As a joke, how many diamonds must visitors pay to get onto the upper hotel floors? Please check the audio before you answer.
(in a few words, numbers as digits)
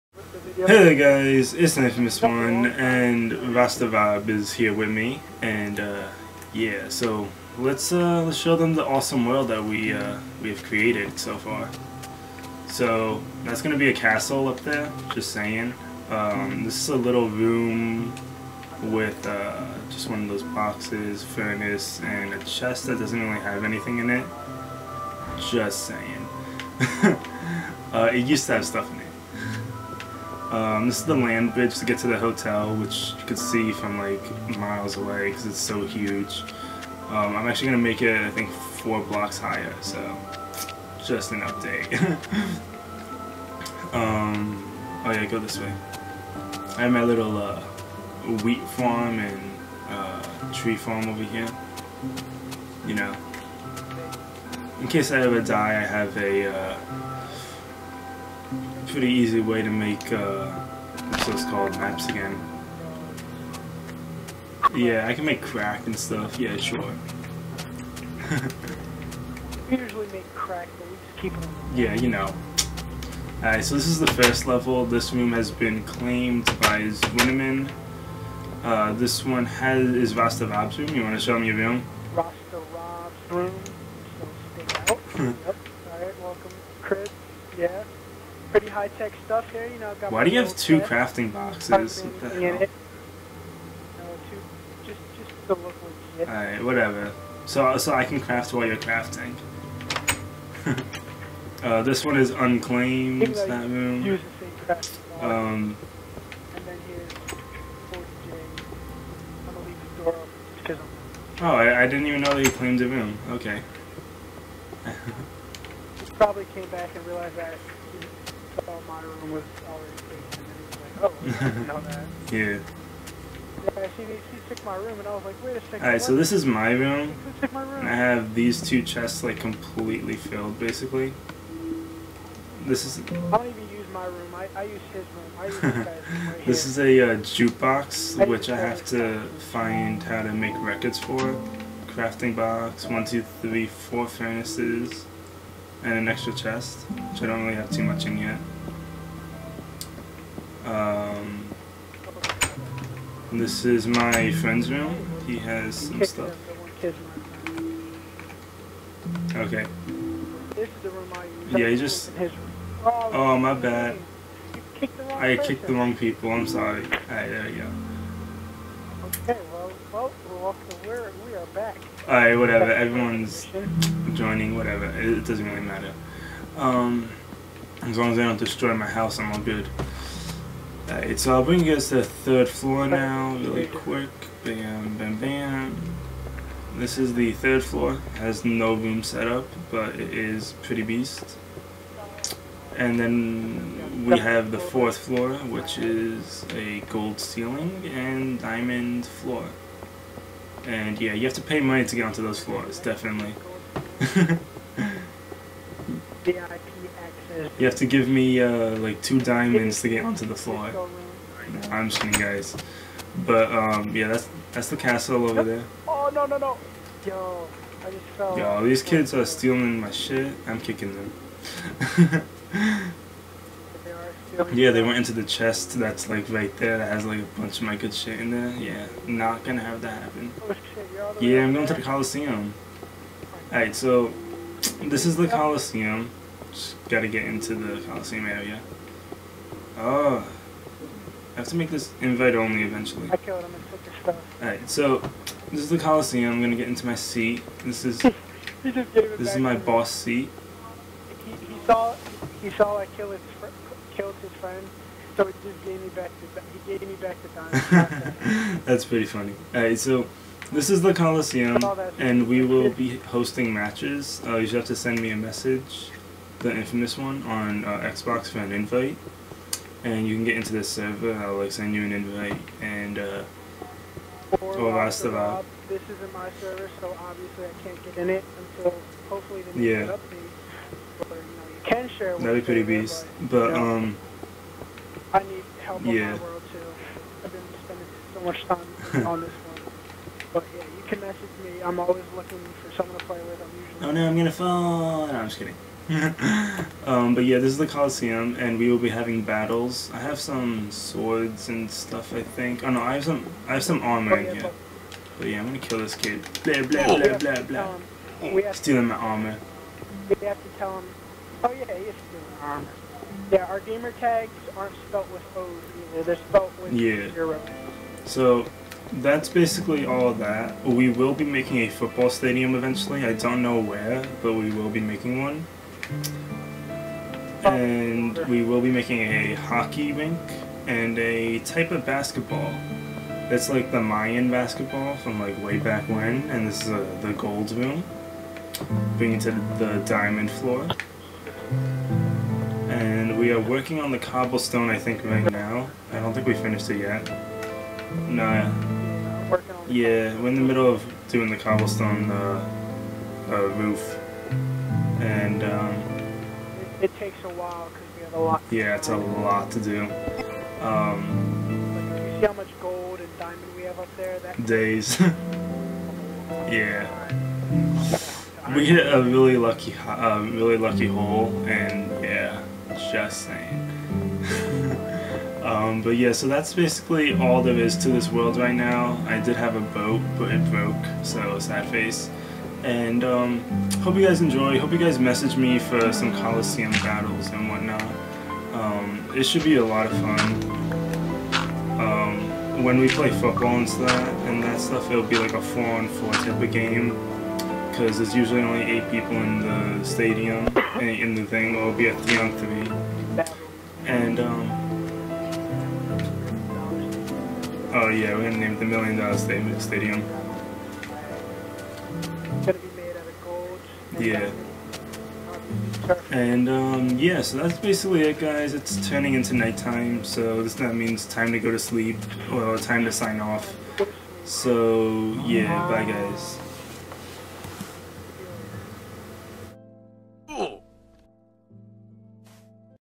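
2.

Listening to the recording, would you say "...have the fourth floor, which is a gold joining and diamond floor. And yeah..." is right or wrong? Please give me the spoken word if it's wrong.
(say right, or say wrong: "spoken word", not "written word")
wrong: "ceiling", not "joining".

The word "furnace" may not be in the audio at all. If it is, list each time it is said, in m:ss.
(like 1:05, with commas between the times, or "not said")
0:21, 2:24.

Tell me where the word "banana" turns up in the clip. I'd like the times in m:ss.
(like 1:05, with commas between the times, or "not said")
not said.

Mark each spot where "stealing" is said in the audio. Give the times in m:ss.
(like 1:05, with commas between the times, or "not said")
3:39, 5:08.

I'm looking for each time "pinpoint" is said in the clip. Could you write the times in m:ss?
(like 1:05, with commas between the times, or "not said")
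not said.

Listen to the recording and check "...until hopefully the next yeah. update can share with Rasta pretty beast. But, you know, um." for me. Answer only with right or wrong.
wrong.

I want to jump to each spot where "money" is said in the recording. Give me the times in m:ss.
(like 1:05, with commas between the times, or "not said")
3:21.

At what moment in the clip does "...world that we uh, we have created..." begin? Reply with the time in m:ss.
0:09.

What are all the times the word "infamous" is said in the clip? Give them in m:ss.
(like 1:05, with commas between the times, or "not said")
0:01, 4:26.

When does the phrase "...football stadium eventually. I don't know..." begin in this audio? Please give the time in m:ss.
5:21.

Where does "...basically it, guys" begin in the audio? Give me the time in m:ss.
6:57.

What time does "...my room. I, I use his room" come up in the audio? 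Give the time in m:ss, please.
2:13.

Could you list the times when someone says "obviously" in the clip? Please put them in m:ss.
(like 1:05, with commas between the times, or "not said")
4:36.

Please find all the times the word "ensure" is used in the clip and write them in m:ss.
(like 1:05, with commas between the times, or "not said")
not said.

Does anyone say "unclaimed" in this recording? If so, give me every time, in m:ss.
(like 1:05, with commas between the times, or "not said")
1:42.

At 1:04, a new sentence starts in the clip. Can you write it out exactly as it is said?
Yeah, I can make crack and stuff, yeah, sure.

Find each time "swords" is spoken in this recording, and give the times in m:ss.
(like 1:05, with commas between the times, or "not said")
5:00.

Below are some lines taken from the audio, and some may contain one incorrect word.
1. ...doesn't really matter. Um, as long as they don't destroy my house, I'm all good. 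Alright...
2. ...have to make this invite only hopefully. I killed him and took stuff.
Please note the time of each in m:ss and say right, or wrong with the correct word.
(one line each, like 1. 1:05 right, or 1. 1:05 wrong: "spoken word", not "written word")
1. 2:55 right
2. 4:01 wrong: "eventually", not "hopefully".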